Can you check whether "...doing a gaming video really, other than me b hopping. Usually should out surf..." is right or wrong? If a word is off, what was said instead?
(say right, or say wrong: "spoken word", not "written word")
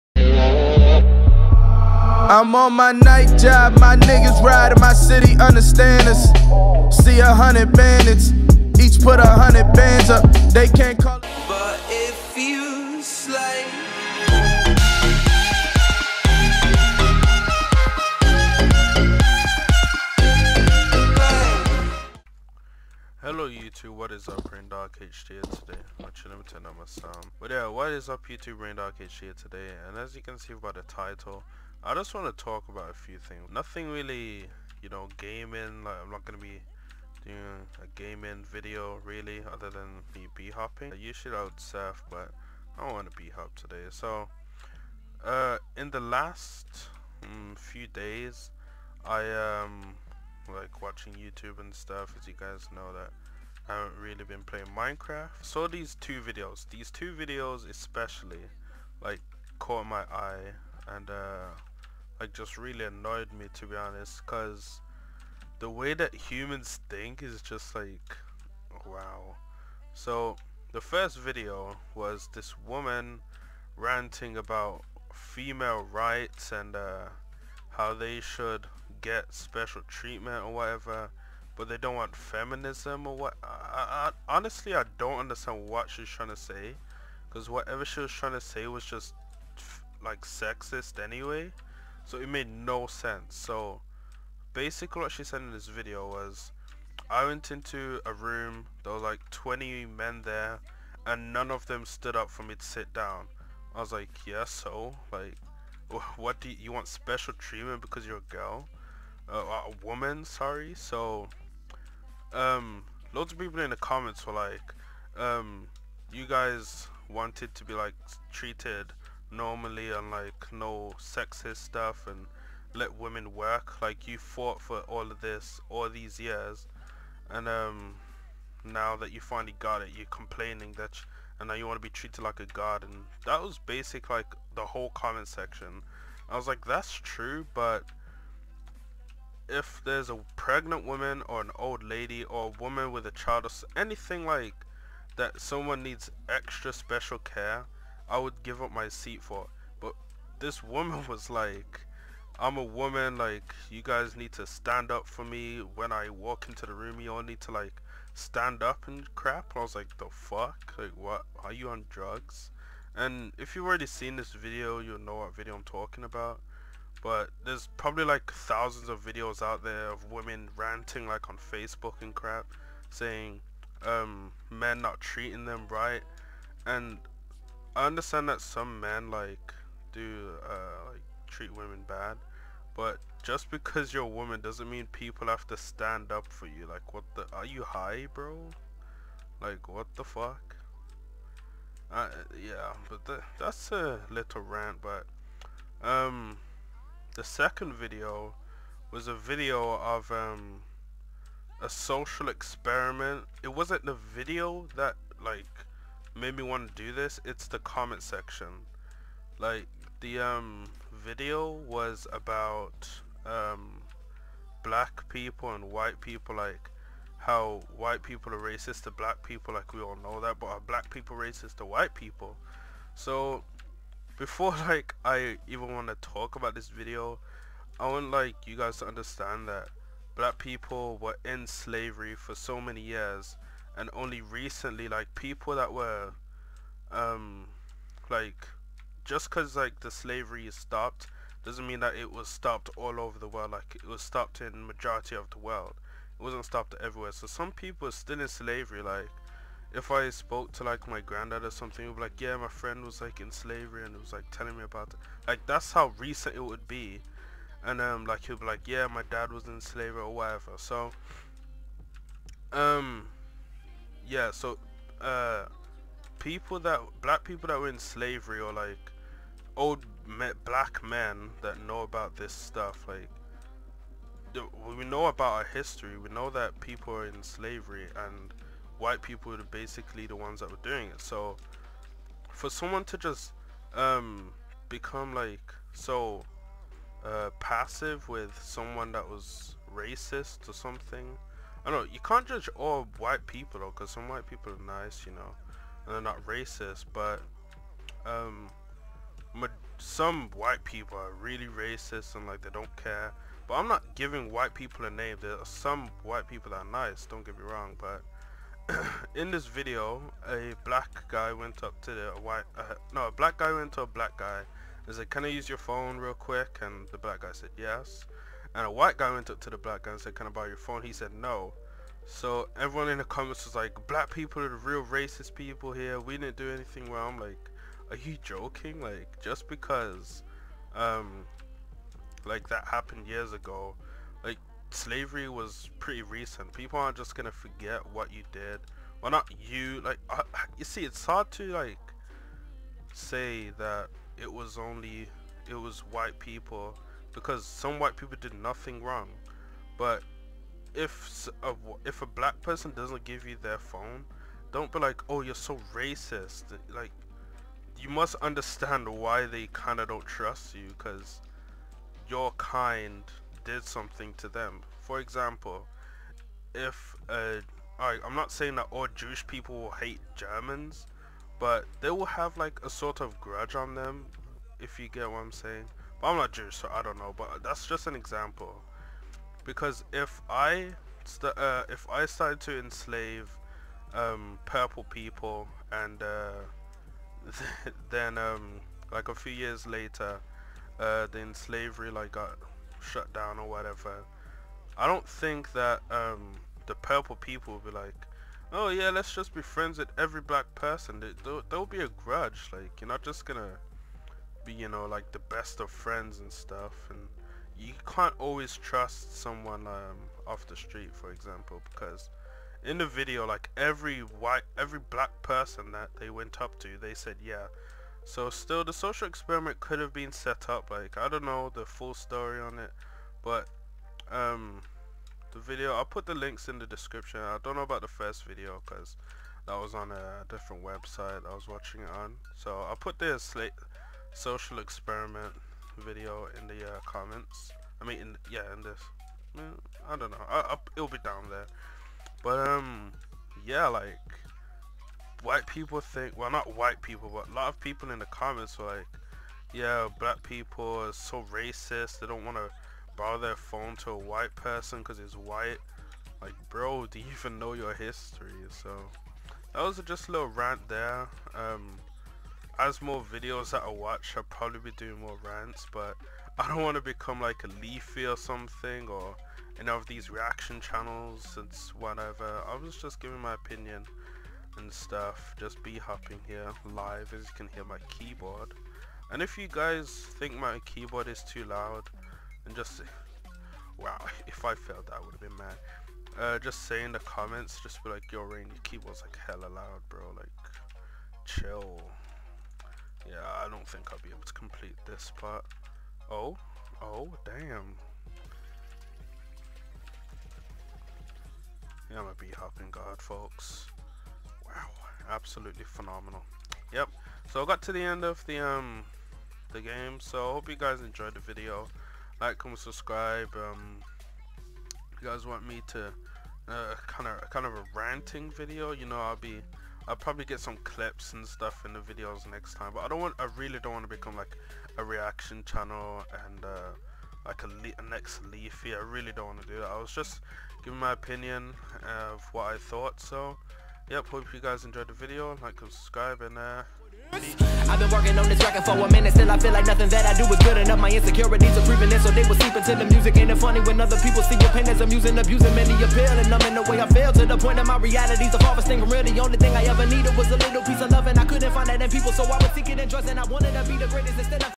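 right.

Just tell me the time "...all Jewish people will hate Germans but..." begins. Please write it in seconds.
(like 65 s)
368 s.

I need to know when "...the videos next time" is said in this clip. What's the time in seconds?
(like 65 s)
521 s.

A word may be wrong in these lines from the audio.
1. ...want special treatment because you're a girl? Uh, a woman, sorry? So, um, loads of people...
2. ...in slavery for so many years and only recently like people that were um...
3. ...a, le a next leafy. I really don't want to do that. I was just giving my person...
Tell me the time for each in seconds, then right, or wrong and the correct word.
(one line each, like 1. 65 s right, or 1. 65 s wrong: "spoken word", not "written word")
1. 106 s right
2. 231 s right
3. 527 s wrong: "opinion", not "person".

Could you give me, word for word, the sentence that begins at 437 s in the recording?
I mean, in, yeah, in this.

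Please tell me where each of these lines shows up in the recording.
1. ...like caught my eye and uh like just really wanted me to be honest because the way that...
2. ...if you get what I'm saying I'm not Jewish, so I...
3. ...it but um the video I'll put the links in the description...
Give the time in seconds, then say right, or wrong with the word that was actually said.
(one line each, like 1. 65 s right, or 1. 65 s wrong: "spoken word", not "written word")
1. 59 s wrong: "annoyed", not "wanted"
2. 374 s right
3. 422 s right.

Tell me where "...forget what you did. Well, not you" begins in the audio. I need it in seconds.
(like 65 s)
337 s.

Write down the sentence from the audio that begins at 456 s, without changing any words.
Like, bro, do you even know your history?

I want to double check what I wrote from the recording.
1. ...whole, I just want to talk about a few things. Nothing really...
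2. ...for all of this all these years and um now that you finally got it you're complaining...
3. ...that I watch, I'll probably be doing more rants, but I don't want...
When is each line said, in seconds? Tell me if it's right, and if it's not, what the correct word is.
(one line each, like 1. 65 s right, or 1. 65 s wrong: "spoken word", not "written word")
1. 30 s wrong: "title", not "whole"
2. 124 s right
3. 463 s right.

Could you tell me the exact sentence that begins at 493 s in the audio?
Yeah, I don't think I'll be able to complete this part.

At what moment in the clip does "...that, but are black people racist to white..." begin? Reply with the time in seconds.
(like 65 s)
220 s.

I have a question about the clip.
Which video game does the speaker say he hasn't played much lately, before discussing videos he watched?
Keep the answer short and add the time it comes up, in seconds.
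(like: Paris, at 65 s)
Minecraft, at 54 s.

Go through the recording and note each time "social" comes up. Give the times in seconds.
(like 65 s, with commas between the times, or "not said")
201 s, 418 s, 434 s.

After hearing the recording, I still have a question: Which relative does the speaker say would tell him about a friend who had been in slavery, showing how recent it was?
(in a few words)
Granddad.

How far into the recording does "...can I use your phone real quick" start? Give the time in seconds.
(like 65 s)
315 s.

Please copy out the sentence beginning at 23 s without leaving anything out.
Hello YouTube, what is up, RainDarg HD here today?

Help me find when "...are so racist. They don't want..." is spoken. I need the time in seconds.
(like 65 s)
450 s.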